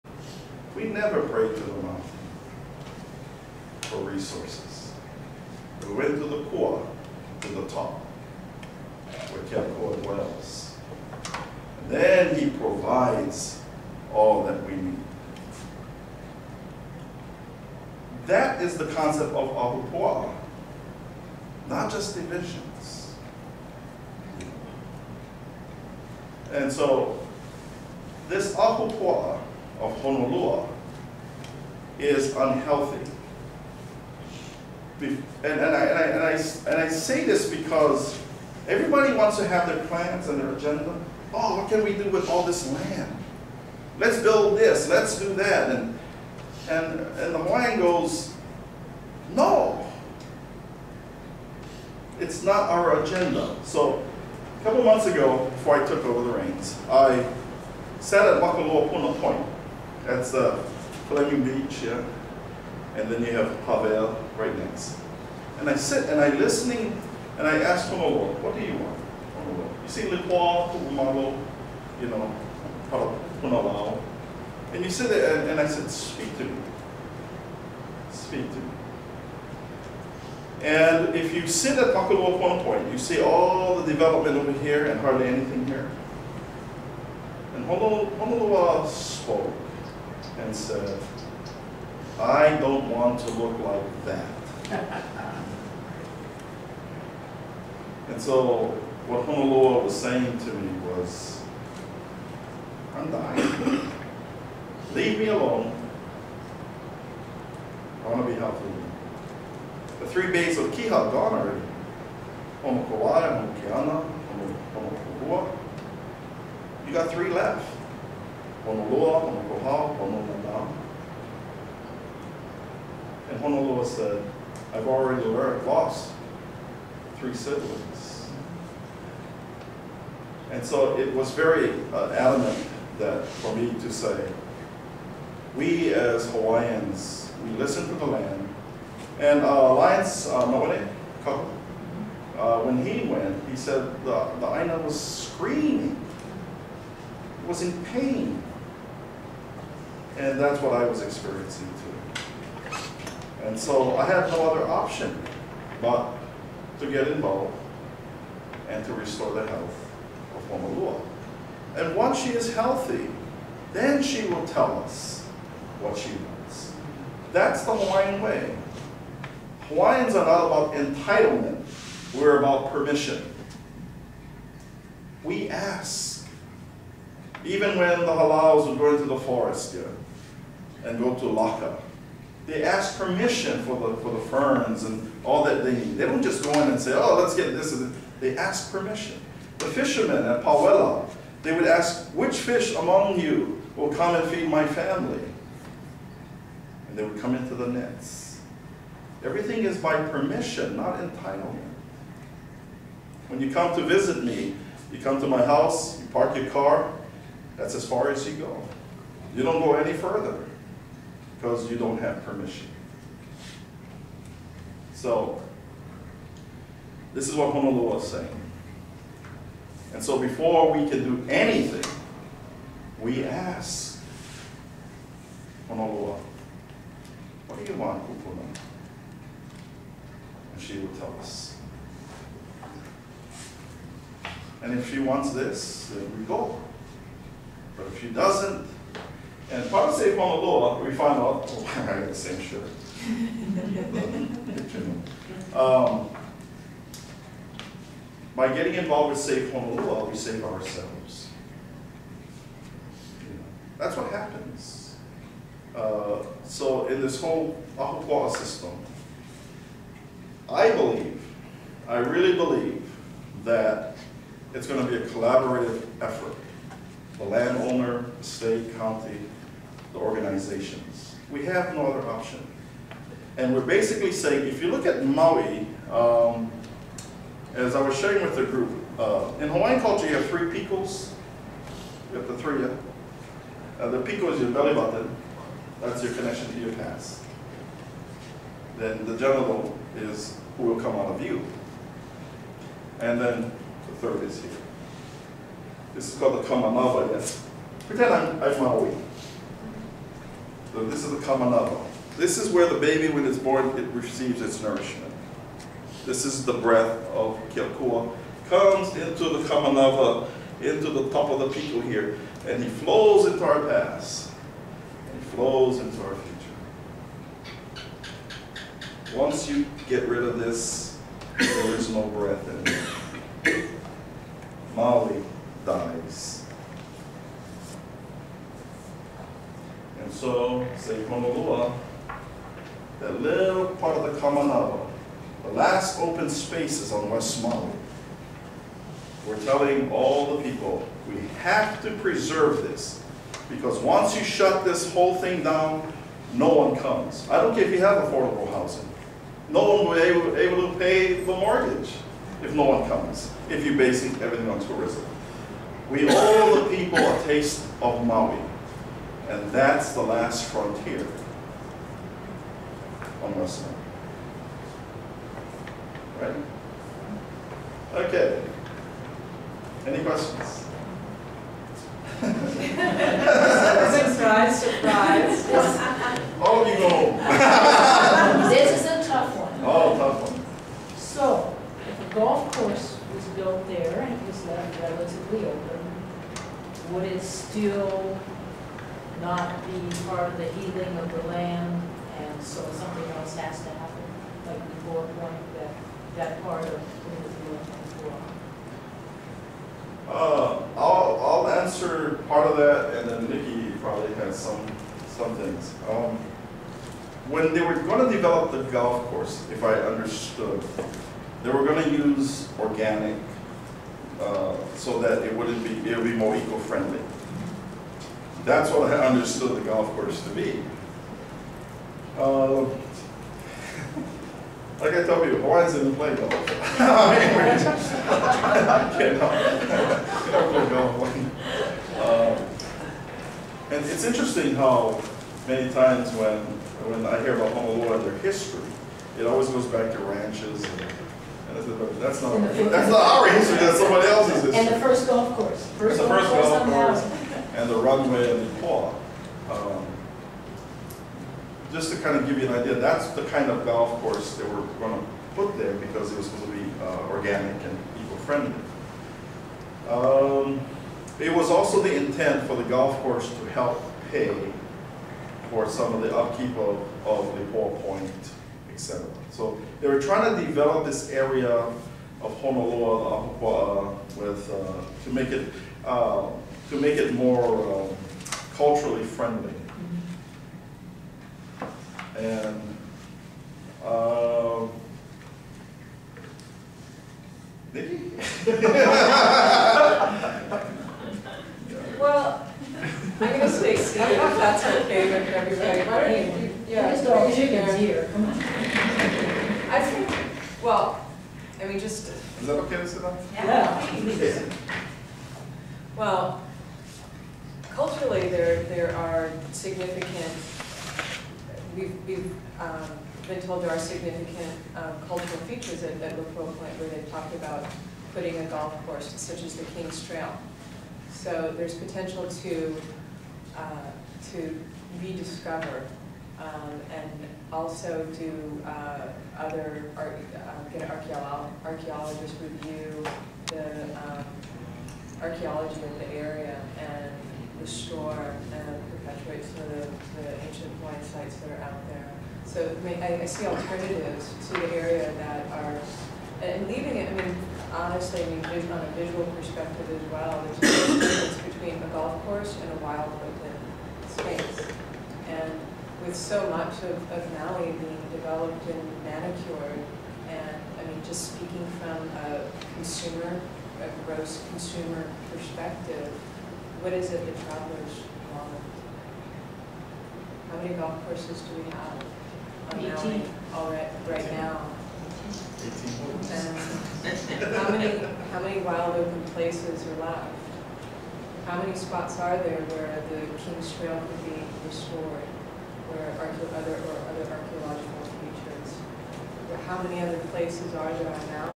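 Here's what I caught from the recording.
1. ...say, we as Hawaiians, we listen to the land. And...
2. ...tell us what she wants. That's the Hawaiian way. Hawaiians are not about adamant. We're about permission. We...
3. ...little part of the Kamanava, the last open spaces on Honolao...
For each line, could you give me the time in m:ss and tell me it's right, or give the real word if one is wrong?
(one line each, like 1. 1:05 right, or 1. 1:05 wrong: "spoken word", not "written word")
1. 2:13 right
2. 2:44 wrong: "entitlement", not "adamant"
3. 5:33 wrong: "West", not "Honolao".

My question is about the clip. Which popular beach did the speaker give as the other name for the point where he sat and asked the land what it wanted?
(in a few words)
Fleming Beach.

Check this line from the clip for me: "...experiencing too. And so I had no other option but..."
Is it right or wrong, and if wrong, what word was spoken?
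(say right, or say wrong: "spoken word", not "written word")
right.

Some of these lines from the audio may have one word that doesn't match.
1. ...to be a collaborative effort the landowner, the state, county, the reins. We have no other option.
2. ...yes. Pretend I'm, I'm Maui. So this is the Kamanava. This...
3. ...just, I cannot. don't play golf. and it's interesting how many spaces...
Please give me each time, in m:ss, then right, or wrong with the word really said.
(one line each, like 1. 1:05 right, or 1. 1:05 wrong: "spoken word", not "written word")
1. 4:24 wrong: "organizations", not "reins"
2. 4:57 right
3. 7:07 wrong: "times", not "spaces".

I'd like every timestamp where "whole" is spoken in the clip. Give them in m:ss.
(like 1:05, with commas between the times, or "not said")
4:17, 5:44.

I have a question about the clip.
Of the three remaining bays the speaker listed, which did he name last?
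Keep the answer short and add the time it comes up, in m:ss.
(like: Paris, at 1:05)
Hononana, at 1:59.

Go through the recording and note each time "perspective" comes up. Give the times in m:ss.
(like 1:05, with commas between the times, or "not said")
9:09, 9:25.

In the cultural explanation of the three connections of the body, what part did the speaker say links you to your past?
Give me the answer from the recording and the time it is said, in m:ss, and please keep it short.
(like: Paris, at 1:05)
belly button, at 4:44.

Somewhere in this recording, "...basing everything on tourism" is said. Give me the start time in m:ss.
5:53.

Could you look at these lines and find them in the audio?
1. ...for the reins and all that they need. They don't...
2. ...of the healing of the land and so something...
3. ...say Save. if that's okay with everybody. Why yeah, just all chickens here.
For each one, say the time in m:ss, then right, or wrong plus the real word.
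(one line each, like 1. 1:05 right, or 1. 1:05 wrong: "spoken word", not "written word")
1. 3:03 wrong: "ferns", not "reins"
2. 6:30 right
3. 8:13 wrong: "Steve", not "Save".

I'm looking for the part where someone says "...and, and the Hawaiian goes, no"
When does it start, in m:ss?
0:46.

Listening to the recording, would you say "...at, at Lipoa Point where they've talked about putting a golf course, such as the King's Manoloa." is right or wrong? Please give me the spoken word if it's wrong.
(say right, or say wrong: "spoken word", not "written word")
wrong: "Trail", not "Manoloa".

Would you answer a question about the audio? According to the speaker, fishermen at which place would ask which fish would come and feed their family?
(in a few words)
Pawela.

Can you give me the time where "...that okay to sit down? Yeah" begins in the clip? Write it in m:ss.
8:22.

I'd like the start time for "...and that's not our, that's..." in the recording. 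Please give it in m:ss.
7:20.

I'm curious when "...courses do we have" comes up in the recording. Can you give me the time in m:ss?
9:31.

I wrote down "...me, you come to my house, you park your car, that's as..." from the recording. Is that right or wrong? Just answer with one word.
right.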